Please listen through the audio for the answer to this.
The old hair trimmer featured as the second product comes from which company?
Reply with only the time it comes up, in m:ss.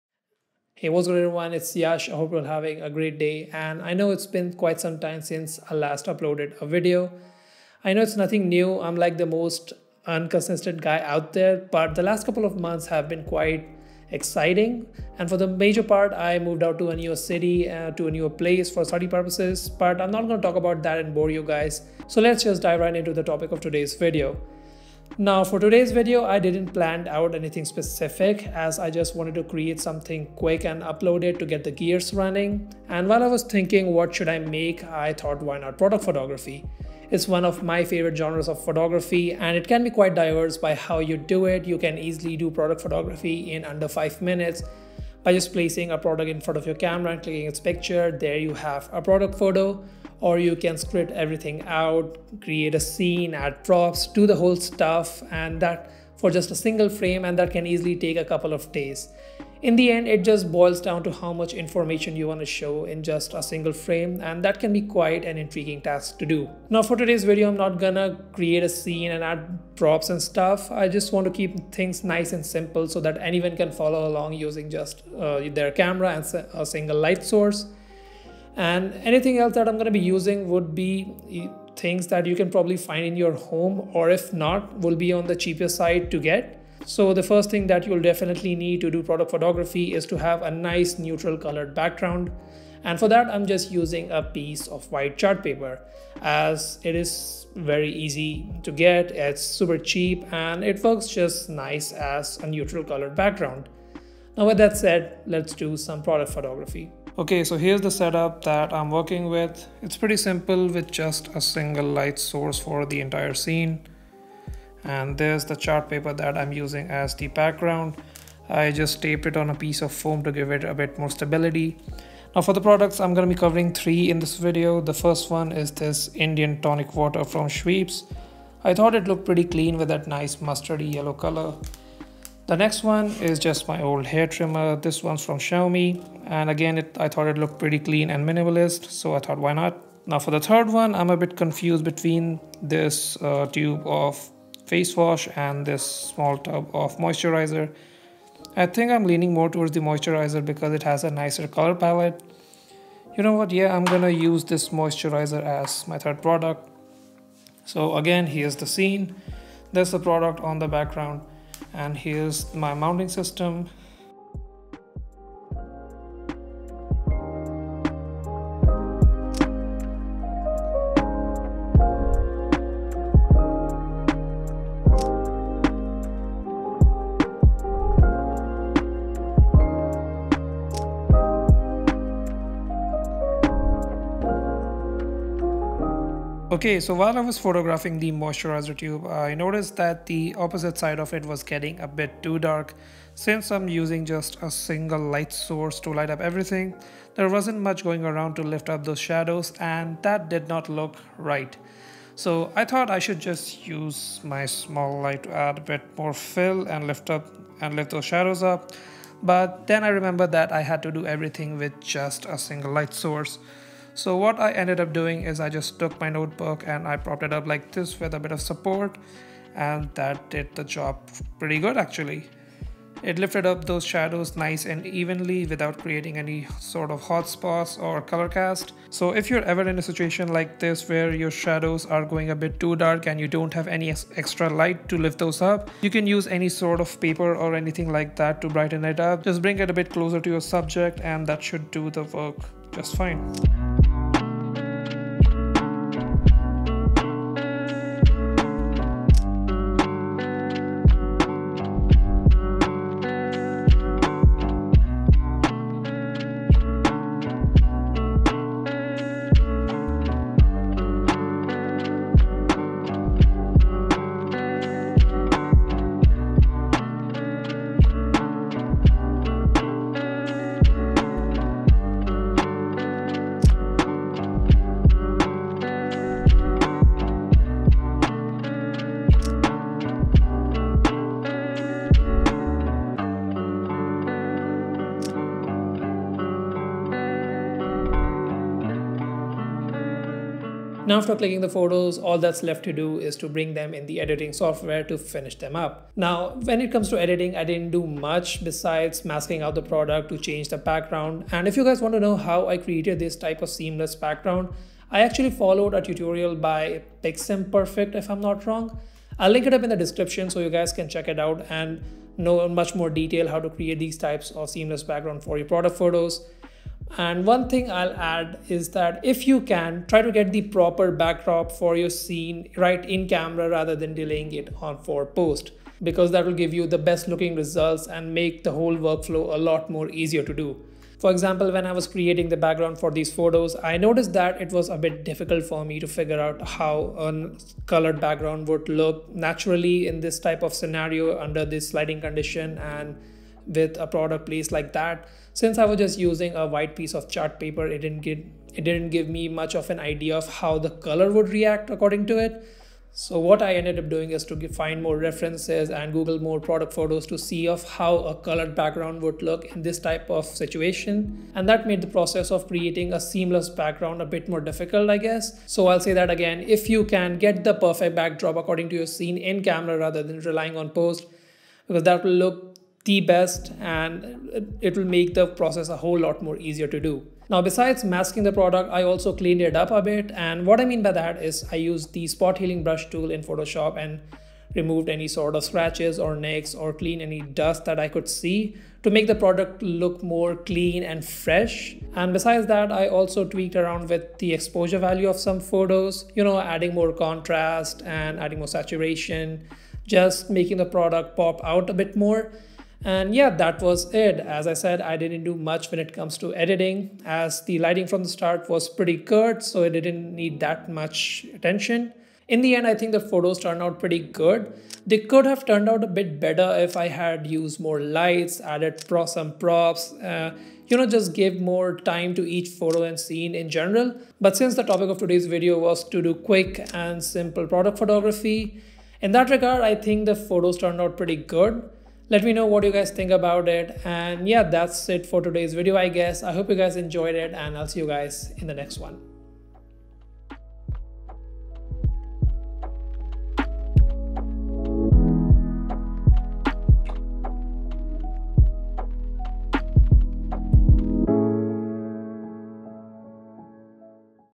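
2:15.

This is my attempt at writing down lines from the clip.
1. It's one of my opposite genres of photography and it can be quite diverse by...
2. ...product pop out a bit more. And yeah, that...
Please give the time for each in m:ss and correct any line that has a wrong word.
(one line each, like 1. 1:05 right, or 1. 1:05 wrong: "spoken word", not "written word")
1. 0:37 wrong: "favorite", not "opposite"
2. 6:40 right.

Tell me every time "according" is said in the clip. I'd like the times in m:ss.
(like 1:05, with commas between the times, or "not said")
5:51, 6:08.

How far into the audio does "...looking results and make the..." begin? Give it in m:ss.
5:27.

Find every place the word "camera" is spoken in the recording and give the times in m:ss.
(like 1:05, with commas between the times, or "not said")
0:46, 1:15, 5:23, 6:09.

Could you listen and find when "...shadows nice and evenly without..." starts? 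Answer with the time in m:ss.
3:43.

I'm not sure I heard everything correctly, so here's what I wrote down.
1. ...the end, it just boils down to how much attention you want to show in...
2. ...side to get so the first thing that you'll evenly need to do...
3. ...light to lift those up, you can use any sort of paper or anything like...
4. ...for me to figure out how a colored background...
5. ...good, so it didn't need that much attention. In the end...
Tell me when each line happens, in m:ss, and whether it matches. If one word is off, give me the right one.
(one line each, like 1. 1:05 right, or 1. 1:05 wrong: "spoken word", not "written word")
1. 0:59 wrong: "information", not "attention"
2. 1:25 wrong: "definitely", not "evenly"
3. 3:54 right
4. 5:35 right
5. 6:48 right.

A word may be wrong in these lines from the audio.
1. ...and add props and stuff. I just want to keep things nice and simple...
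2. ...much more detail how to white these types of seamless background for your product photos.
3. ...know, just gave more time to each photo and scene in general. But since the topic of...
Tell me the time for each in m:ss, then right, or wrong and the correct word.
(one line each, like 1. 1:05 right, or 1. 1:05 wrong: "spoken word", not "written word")
1. 1:09 right
2. 5:12 wrong: "create", not "white"
3. 7:00 right.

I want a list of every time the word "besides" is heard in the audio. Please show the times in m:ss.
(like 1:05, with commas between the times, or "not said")
4:58, 6:17, 6:32.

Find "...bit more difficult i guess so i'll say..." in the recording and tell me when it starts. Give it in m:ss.
6:04.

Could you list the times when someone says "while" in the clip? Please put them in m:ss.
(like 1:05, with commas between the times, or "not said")
0:33, 3:06.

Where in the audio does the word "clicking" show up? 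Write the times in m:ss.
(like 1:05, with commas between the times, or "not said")
0:47, 4:51.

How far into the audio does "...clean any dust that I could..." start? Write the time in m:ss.
6:26.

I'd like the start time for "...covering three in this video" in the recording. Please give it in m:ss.
2:03.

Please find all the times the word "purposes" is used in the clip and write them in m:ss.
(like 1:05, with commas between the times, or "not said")
0:19.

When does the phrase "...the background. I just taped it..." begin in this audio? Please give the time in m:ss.
1:57.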